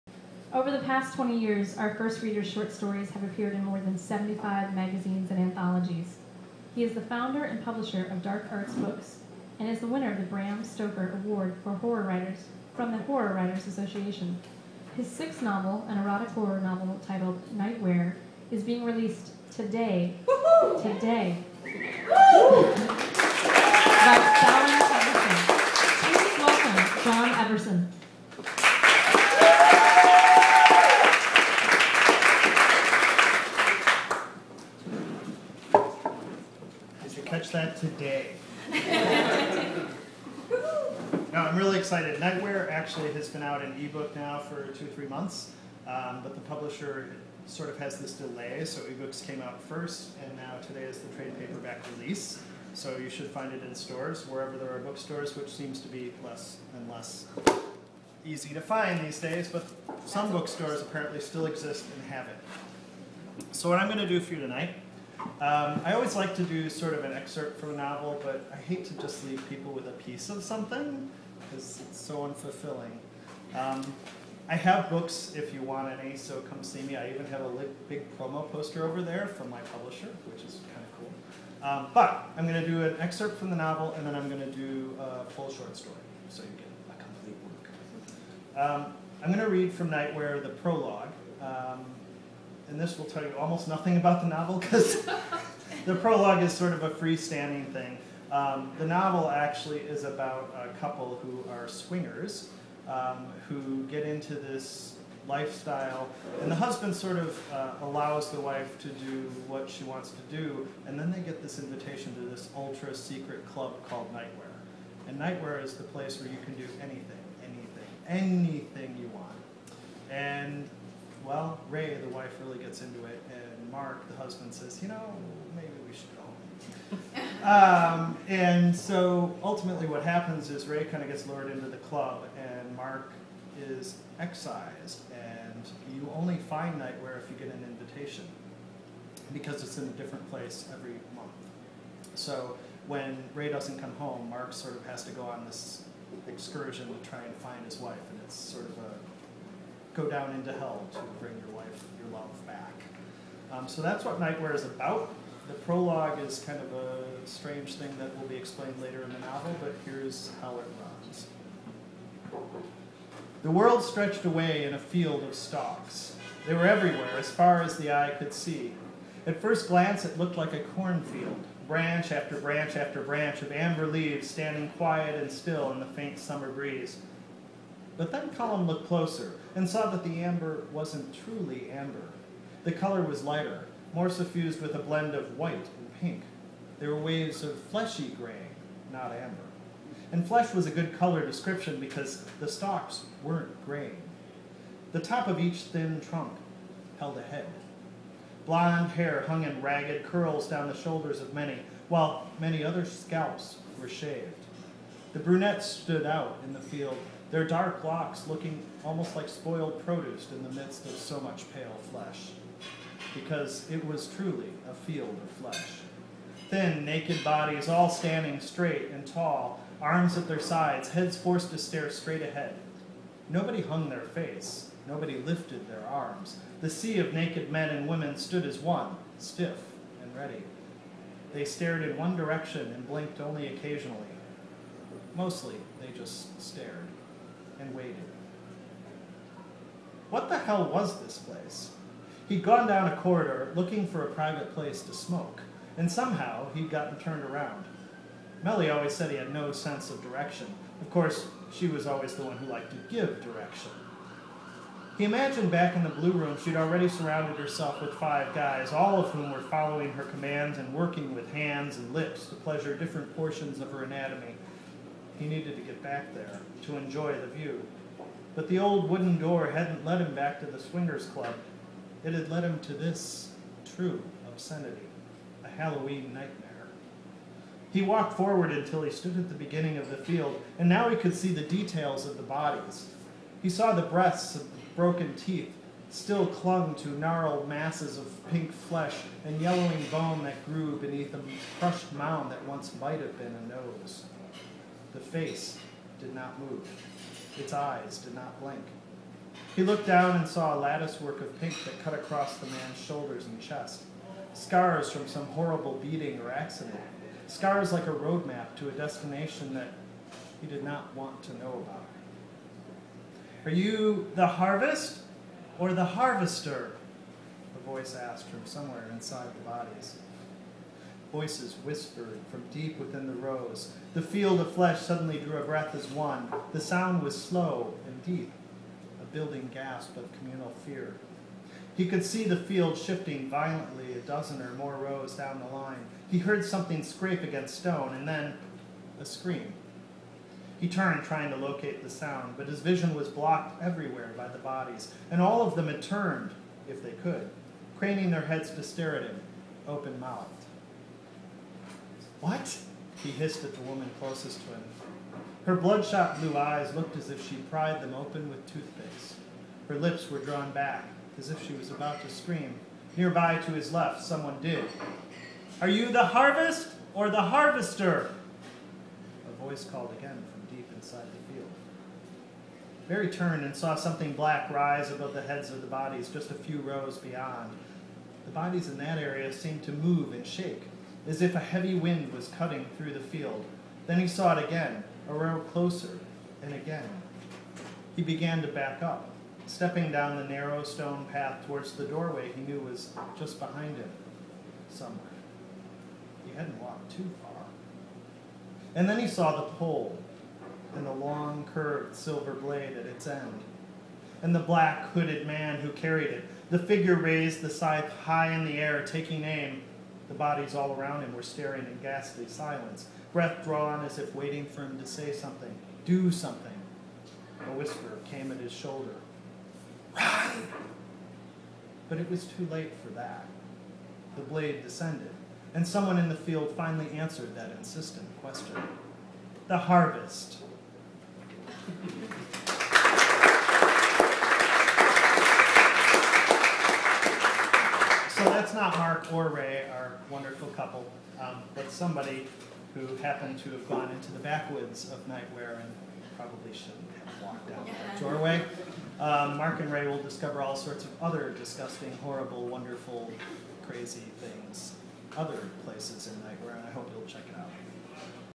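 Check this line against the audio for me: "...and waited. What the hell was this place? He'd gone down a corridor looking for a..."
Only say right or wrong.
right.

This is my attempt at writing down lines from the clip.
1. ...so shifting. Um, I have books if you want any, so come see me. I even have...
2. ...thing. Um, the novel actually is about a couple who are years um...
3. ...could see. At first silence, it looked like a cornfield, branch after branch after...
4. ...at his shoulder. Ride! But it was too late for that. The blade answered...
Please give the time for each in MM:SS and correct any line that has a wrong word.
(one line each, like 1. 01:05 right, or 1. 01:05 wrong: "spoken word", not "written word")
1. 01:11 wrong: "unfulfilling", not "shifting"
2. 01:37 wrong: "swingers", not "years"
3. 02:48 wrong: "glance", not "silence"
4. 06:58 wrong: "descended", not "answered".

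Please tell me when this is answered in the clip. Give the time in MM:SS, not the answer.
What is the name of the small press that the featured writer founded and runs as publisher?
00:08.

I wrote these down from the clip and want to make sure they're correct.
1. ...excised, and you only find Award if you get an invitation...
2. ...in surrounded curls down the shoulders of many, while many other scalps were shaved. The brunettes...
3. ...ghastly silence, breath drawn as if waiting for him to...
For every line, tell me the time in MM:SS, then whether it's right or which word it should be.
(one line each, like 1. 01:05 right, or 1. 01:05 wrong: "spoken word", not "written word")
1. 02:14 wrong: "Nightwhere", not "Award"
2. 03:19 wrong: "ragged", not "surrounded"
3. 06:51 right.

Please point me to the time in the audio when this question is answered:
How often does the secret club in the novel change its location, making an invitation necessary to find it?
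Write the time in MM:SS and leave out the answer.
02:20.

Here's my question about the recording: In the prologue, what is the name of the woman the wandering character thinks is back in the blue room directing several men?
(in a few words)
Melly.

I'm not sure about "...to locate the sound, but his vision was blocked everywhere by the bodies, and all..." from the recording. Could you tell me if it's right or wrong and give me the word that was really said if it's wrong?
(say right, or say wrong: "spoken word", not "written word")
right.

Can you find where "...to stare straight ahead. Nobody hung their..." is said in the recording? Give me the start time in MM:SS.
03:41.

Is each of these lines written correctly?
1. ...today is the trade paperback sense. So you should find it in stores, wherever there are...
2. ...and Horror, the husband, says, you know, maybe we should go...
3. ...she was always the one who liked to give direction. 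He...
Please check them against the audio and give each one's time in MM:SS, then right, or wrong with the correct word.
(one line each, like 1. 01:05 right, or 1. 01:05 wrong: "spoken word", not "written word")
1. 00:50 wrong: "release", not "sense"
2. 02:03 wrong: "Mark", not "Horror"
3. 04:11 right.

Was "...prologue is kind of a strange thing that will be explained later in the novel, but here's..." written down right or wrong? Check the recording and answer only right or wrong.
right.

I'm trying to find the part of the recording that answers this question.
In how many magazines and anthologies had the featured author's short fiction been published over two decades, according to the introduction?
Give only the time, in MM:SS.
00:03.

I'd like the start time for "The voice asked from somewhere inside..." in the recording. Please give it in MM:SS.
05:17.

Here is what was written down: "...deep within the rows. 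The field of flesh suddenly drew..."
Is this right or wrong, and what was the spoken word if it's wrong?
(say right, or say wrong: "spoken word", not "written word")
right.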